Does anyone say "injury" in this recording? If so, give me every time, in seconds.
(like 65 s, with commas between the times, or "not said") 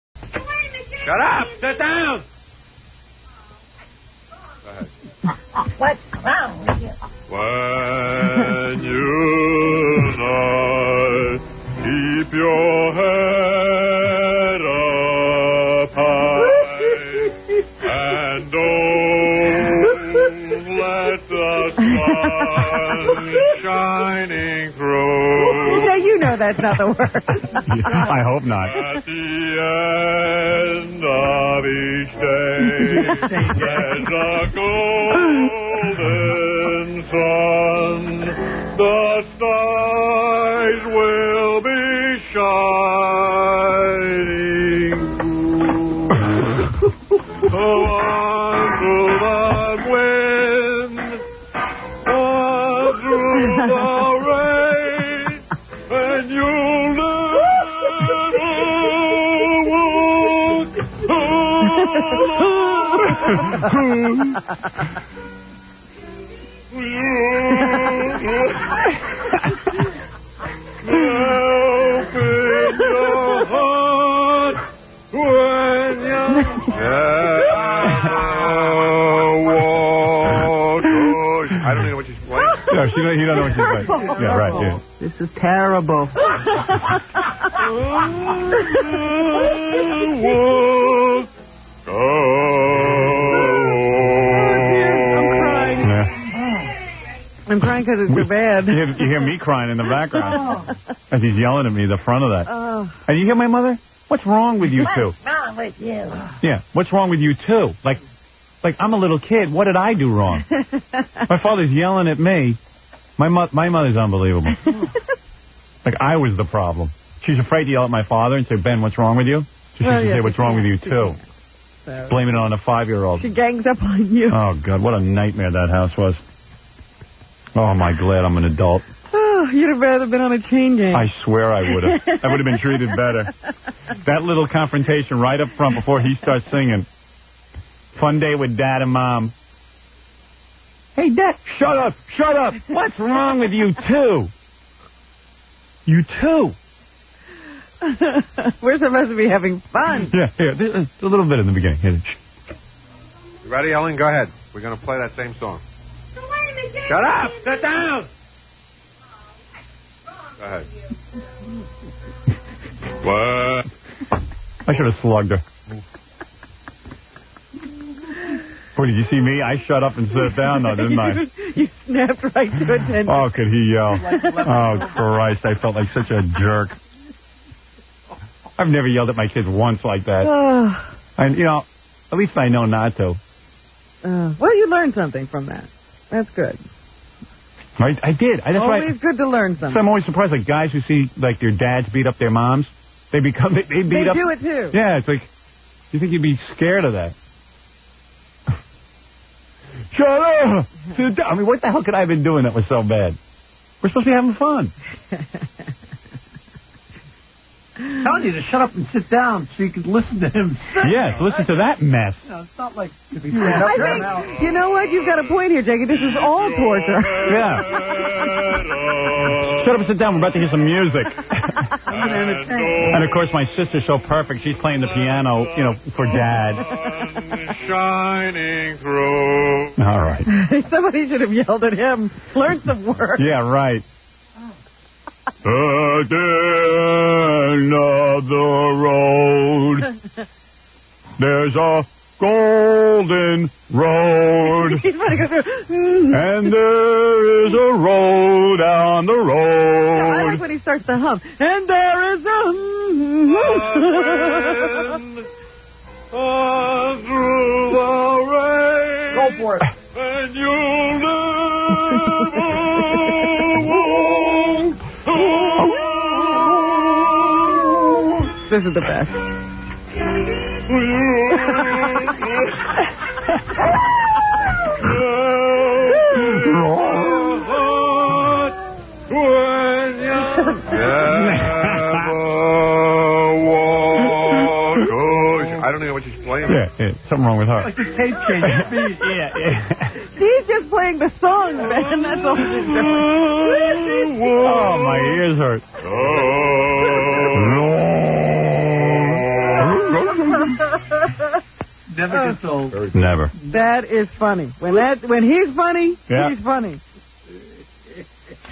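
not said.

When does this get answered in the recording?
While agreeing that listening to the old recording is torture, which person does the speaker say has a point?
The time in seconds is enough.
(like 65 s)
215 s.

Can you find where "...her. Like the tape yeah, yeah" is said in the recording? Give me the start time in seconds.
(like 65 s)
287 s.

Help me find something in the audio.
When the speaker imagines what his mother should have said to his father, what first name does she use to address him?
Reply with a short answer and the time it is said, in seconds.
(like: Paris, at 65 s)
Ben, at 118 s.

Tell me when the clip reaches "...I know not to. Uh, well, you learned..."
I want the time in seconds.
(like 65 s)
182 s.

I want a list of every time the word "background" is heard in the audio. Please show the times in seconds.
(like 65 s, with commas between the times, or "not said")
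99 s.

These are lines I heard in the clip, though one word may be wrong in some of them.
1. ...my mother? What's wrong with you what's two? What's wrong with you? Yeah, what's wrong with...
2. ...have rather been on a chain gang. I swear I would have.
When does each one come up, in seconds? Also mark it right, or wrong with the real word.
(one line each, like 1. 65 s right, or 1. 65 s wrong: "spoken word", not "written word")
1. 103 s right
2. 129 s right.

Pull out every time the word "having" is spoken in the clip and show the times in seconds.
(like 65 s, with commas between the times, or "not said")
149 s, 204 s.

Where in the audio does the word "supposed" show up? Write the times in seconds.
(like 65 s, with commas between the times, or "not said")
148 s, 203 s.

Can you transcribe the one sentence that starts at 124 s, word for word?
Oh, God, what a nightmare that house was.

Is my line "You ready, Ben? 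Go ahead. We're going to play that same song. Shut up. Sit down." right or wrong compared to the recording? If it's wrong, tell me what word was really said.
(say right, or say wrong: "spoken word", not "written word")
wrong: "Ellen", not "Ben".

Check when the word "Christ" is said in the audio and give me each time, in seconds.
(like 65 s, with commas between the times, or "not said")
174 s.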